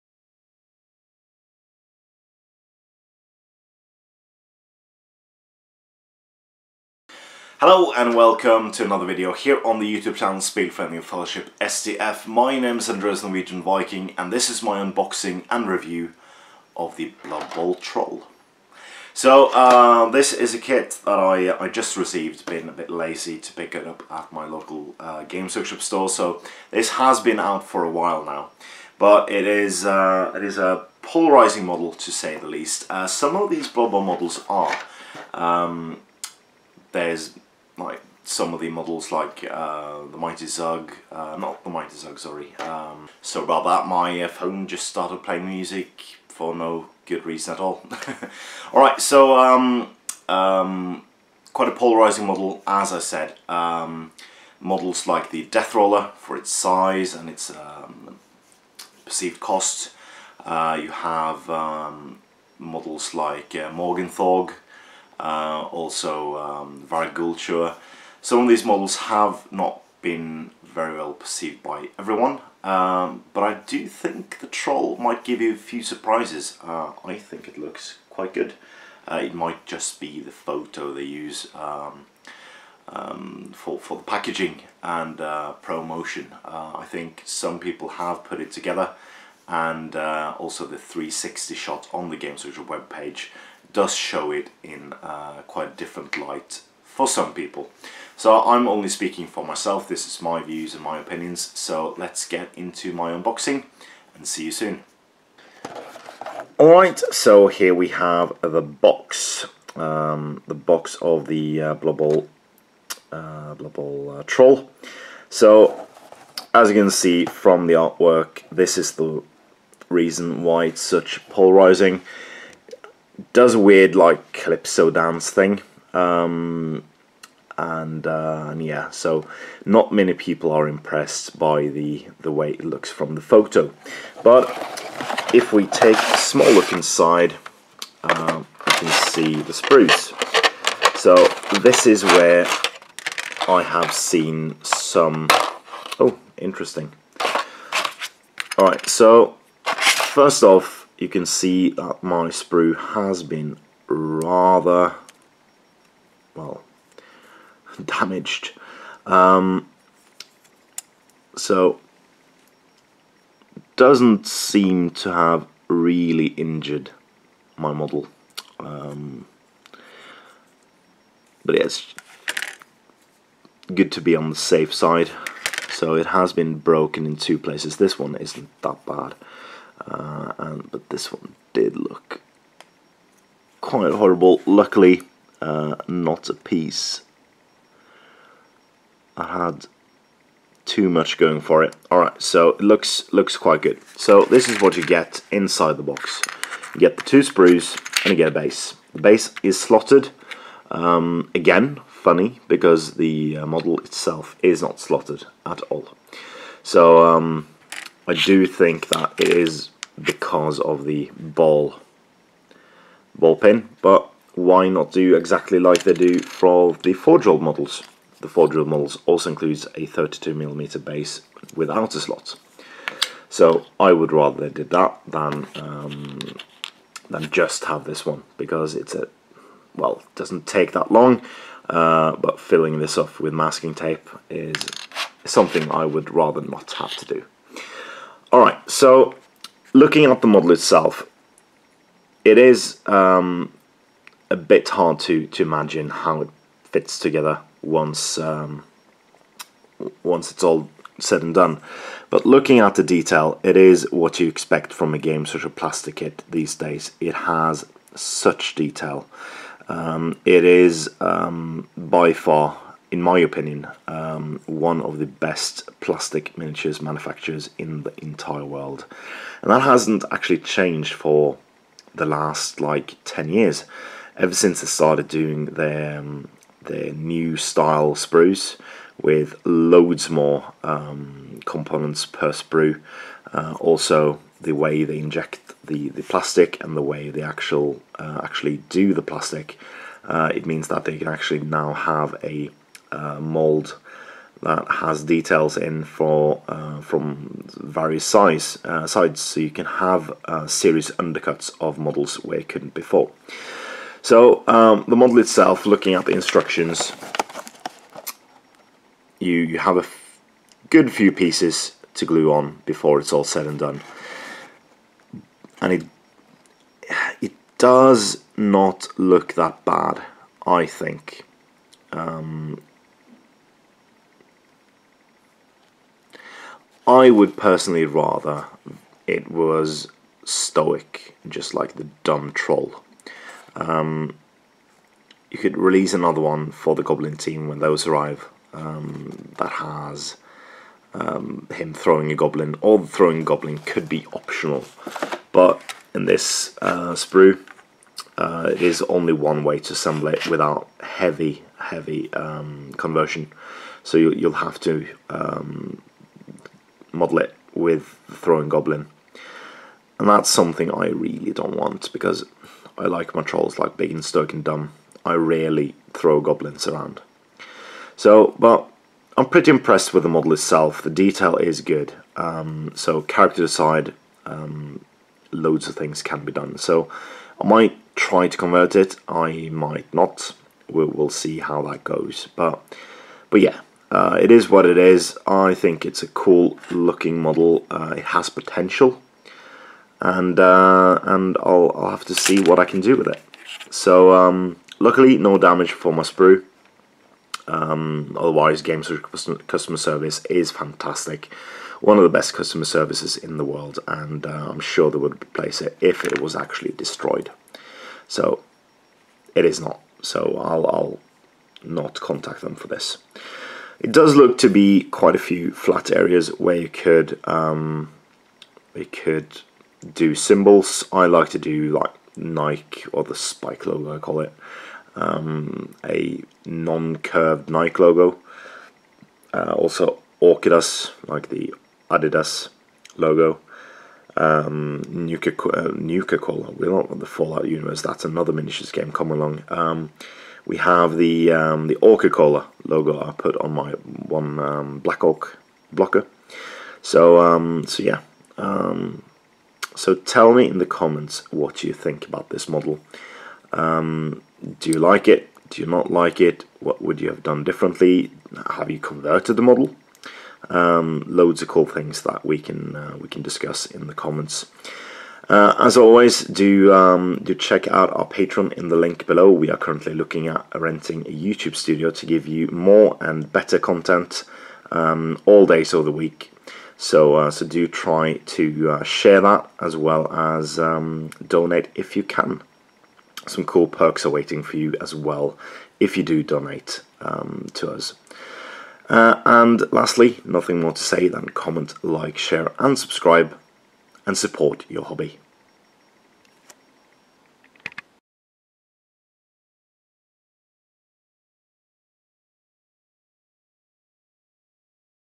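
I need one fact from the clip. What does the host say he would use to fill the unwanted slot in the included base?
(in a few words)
masking tape.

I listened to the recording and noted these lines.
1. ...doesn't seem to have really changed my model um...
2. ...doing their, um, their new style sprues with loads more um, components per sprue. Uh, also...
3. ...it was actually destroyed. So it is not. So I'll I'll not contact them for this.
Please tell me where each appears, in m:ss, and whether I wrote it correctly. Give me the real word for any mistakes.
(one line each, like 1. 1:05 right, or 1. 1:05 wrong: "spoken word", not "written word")
1. 2:43 wrong: "injured", not "changed"
2. 4:35 right
3. 6:46 right.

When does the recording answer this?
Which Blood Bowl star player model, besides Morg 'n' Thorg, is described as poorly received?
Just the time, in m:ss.
1:06.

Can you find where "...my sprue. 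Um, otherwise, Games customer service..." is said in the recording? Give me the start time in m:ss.
6:35.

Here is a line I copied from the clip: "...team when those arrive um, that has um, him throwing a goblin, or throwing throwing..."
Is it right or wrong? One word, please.
right.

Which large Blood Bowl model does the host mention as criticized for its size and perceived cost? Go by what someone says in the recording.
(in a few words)
Death Roller.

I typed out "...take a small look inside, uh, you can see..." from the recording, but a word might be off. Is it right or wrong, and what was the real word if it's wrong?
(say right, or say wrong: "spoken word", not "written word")
right.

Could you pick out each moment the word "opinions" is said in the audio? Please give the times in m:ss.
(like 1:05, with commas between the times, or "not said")
1:40, 4:23.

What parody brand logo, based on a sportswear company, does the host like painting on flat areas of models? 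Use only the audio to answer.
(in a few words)
Orcidas.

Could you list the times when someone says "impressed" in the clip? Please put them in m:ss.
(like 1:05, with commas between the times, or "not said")
2:10, 6:09.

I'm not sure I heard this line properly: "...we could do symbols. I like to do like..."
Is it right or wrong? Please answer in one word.
right.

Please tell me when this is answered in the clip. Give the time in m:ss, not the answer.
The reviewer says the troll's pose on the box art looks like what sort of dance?
2:04.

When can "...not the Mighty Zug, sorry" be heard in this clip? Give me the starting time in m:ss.
0:41.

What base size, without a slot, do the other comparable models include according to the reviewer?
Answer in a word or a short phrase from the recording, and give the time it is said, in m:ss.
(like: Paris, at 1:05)
32mm, at 3:39.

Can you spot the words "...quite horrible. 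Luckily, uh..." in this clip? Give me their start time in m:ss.
3:03.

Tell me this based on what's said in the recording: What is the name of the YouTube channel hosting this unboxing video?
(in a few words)
Spillforeningen Fellowship STF.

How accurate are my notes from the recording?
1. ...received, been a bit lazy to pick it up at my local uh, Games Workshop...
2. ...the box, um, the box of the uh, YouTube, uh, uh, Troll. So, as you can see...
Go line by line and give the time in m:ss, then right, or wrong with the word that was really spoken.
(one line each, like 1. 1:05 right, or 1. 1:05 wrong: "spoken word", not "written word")
1. 0:21 right
2. 1:48 wrong: "Blubble", not "YouTube".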